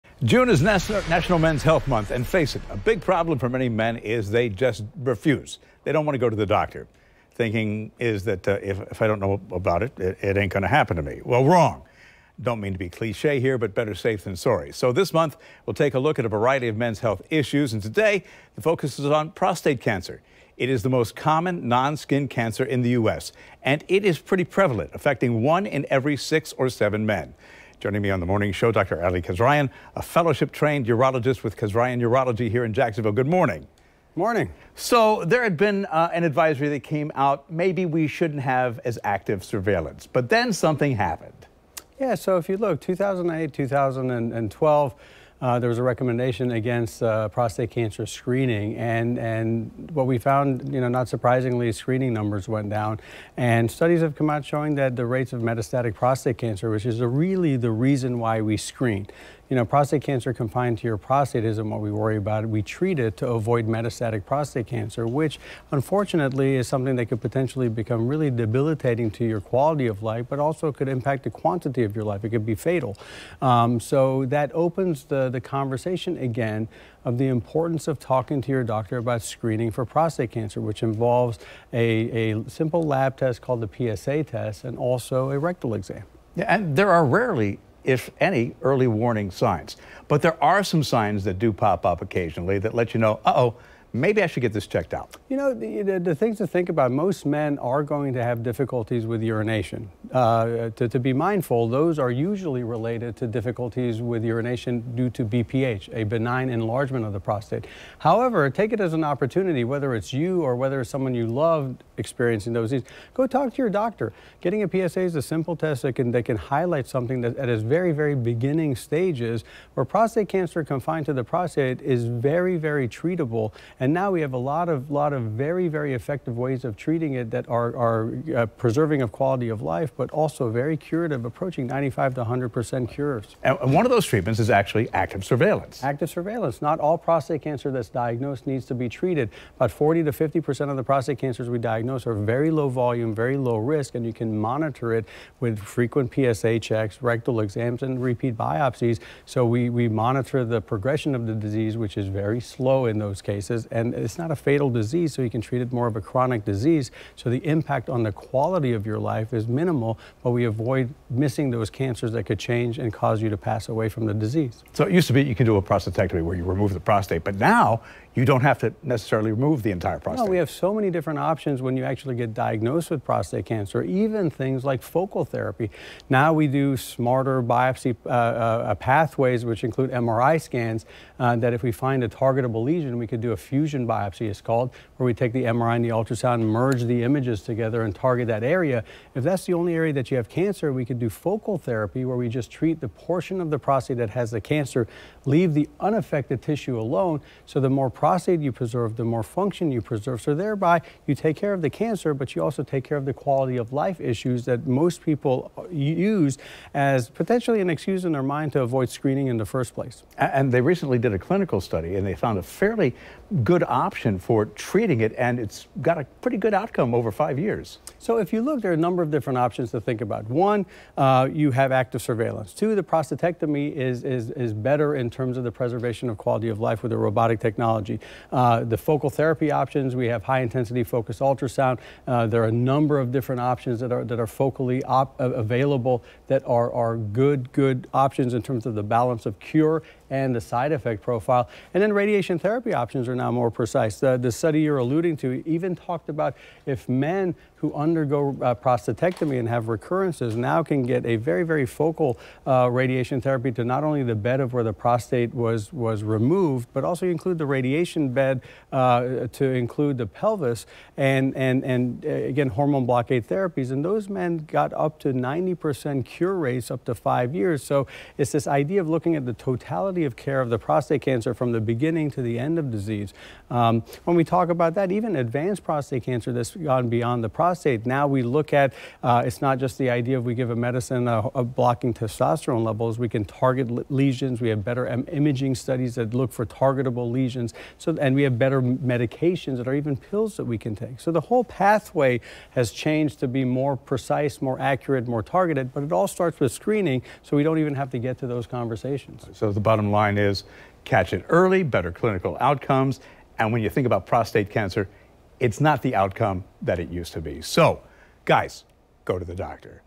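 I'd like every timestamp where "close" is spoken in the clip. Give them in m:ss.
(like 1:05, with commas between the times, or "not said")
not said.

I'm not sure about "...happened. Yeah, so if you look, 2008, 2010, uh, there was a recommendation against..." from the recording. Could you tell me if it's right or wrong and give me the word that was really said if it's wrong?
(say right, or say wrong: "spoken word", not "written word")
wrong: "2012", not "2010".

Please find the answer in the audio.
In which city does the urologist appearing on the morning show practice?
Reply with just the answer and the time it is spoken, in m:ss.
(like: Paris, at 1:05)
Jacksonville, at 0:32.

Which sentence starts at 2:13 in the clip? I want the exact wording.
And one of those treatments is actually active surveillance.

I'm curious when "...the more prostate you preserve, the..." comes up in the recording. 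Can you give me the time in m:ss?
3:17.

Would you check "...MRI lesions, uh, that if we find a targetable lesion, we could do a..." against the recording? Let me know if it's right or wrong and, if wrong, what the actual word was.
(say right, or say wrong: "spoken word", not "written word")
wrong: "scans", not "lesions".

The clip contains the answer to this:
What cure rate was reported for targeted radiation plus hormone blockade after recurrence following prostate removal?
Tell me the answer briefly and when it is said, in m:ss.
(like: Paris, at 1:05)
90%, at 4:25.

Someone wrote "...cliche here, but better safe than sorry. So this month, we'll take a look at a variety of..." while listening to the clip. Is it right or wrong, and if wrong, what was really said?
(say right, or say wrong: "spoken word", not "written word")
right.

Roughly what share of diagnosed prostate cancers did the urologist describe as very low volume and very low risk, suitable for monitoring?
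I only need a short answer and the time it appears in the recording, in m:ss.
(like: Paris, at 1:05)
40 to 50%, at 2:19.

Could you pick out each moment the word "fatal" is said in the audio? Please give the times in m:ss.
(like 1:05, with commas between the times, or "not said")
1:12, 2:34.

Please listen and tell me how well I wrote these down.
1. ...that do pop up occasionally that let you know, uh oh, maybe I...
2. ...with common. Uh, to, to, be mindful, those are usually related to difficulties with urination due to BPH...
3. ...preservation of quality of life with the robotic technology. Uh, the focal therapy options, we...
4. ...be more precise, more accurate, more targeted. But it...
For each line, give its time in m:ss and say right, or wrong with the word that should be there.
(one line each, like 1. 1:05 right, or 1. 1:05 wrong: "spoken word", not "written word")
1. 1:31 right
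2. 1:39 wrong: "urination", not "common"
3. 3:45 right
4. 4:53 right.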